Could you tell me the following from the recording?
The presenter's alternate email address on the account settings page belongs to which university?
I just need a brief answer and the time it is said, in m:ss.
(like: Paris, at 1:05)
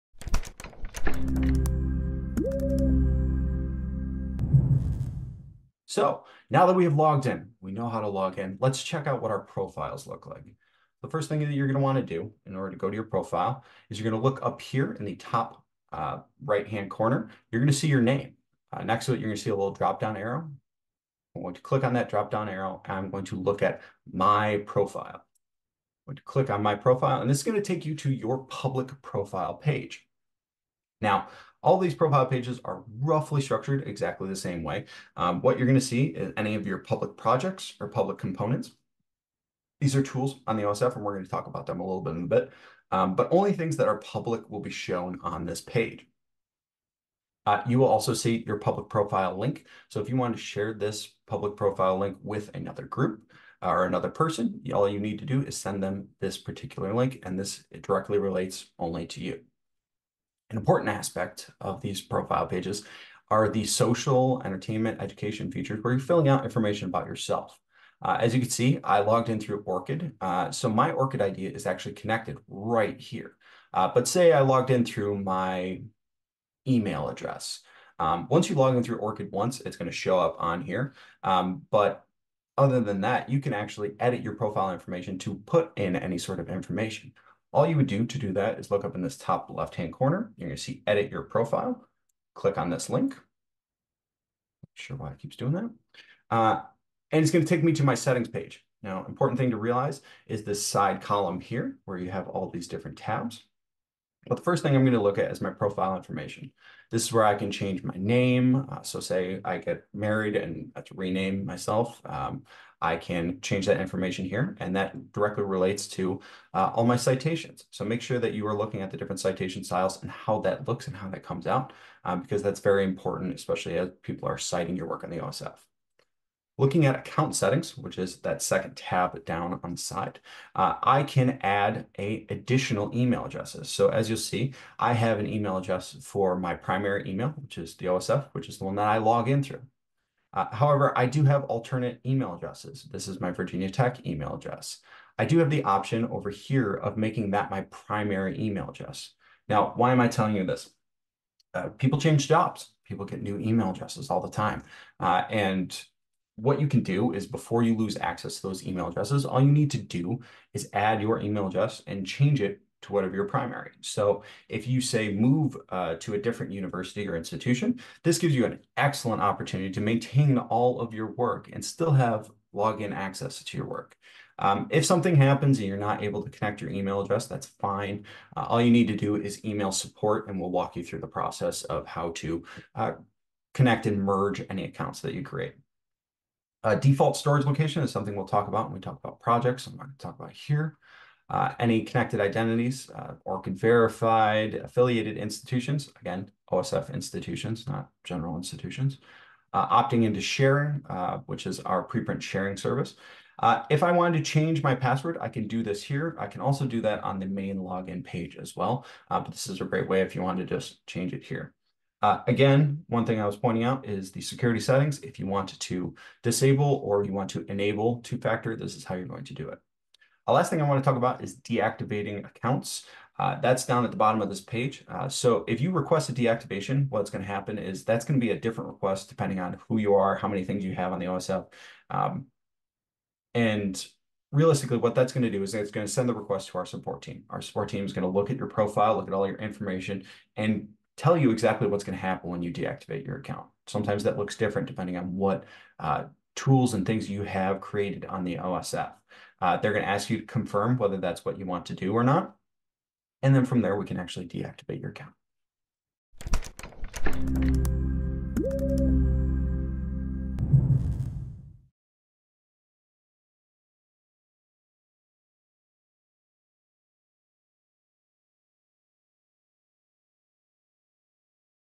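Virginia Tech, at 2:23.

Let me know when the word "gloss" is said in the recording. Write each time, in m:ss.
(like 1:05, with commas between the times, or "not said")
not said.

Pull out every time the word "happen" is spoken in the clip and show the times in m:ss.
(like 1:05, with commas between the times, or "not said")
2:55, 3:47, 4:02.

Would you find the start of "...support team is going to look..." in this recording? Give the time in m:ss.
3:57.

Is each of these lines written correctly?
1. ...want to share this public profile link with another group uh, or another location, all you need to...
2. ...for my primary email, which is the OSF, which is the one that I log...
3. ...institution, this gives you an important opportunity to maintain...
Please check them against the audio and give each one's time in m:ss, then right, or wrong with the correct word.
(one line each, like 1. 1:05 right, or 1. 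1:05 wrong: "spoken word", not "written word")
1. 0:50 wrong: "person", not "location"
2. 2:16 right
3. 2:47 wrong: "excellent", not "important".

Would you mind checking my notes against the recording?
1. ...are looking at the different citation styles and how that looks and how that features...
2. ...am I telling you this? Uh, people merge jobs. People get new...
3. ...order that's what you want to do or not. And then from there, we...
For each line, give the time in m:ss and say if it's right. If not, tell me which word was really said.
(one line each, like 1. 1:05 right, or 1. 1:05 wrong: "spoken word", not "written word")
1. 1:58 wrong: "comes", not "features"
2. 2:29 wrong: "change", not "merge"
3. 4:10 wrong: "whether", not "order".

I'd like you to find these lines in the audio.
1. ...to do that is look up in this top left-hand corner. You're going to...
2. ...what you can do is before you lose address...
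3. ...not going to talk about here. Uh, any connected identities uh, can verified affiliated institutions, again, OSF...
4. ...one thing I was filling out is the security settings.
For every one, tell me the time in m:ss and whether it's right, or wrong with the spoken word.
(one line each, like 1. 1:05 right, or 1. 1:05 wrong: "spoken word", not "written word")
1. 1:28 right
2. 2:36 wrong: "access", not "address"
3. 3:09 right
4. 3:32 wrong: "pointing", not "filling".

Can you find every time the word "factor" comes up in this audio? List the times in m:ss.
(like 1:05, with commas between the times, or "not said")
3:38.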